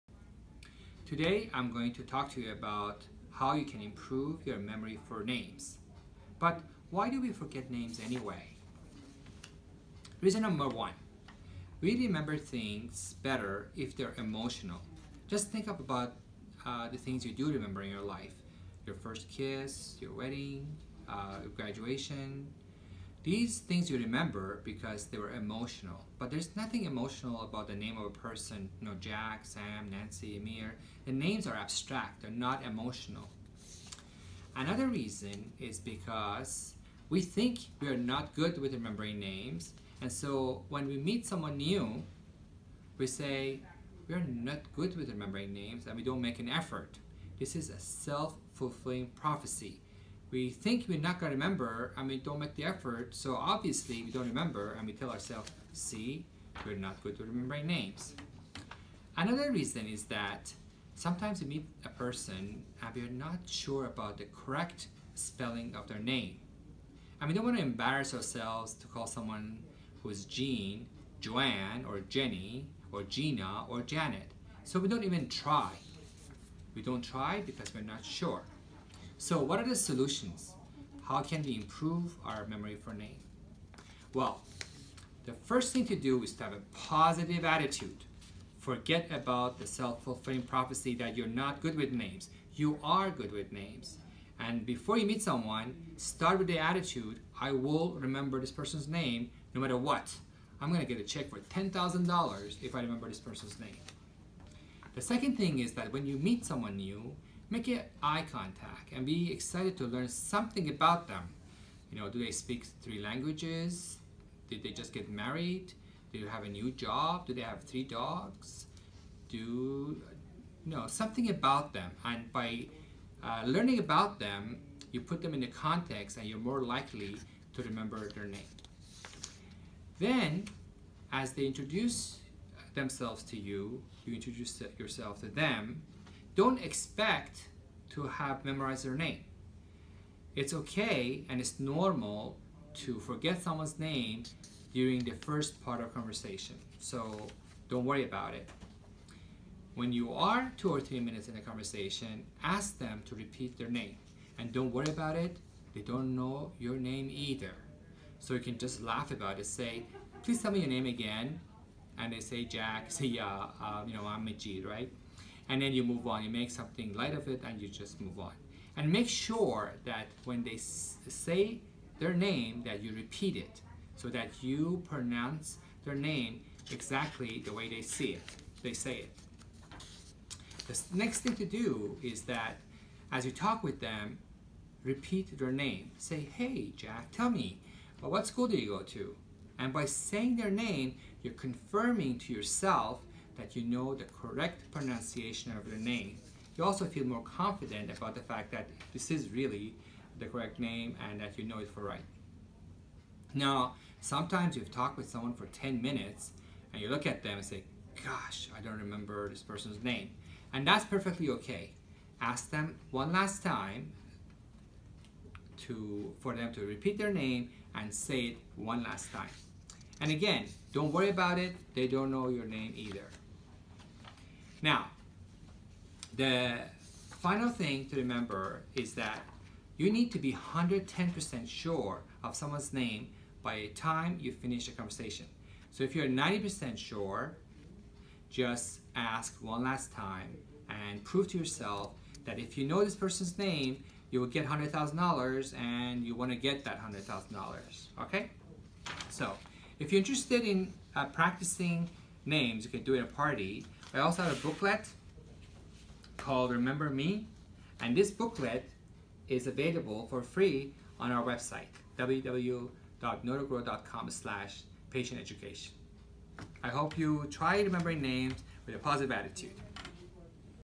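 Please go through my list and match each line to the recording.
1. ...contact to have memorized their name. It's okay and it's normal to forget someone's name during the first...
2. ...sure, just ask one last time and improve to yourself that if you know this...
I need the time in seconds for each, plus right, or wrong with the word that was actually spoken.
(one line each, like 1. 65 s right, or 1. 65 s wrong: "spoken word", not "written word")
1. 136 s wrong: "expect", not "contact"
2. 236 s wrong: "prove", not "improve".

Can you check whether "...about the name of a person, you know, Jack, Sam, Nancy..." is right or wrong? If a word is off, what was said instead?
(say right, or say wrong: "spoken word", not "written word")
right.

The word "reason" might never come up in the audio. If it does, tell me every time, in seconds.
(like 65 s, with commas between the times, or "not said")
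10 s, 34 s, 59 s.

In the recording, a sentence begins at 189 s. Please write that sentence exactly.
And by saying their name, you're confirming to yourself that you know the correct pronunciation of your name.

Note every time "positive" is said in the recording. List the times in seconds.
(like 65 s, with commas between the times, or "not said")
86 s, 268 s.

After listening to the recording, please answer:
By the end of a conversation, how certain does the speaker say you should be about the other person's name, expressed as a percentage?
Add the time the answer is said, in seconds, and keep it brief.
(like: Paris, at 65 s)
110%, at 230 s.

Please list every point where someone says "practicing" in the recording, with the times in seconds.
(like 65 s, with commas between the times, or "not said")
251 s.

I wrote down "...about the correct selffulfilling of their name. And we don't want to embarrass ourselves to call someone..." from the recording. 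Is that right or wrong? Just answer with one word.
wrong.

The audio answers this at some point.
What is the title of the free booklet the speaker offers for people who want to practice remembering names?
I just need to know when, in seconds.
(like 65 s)
256 s.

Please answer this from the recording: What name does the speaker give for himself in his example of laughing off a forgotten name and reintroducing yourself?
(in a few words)
Majid.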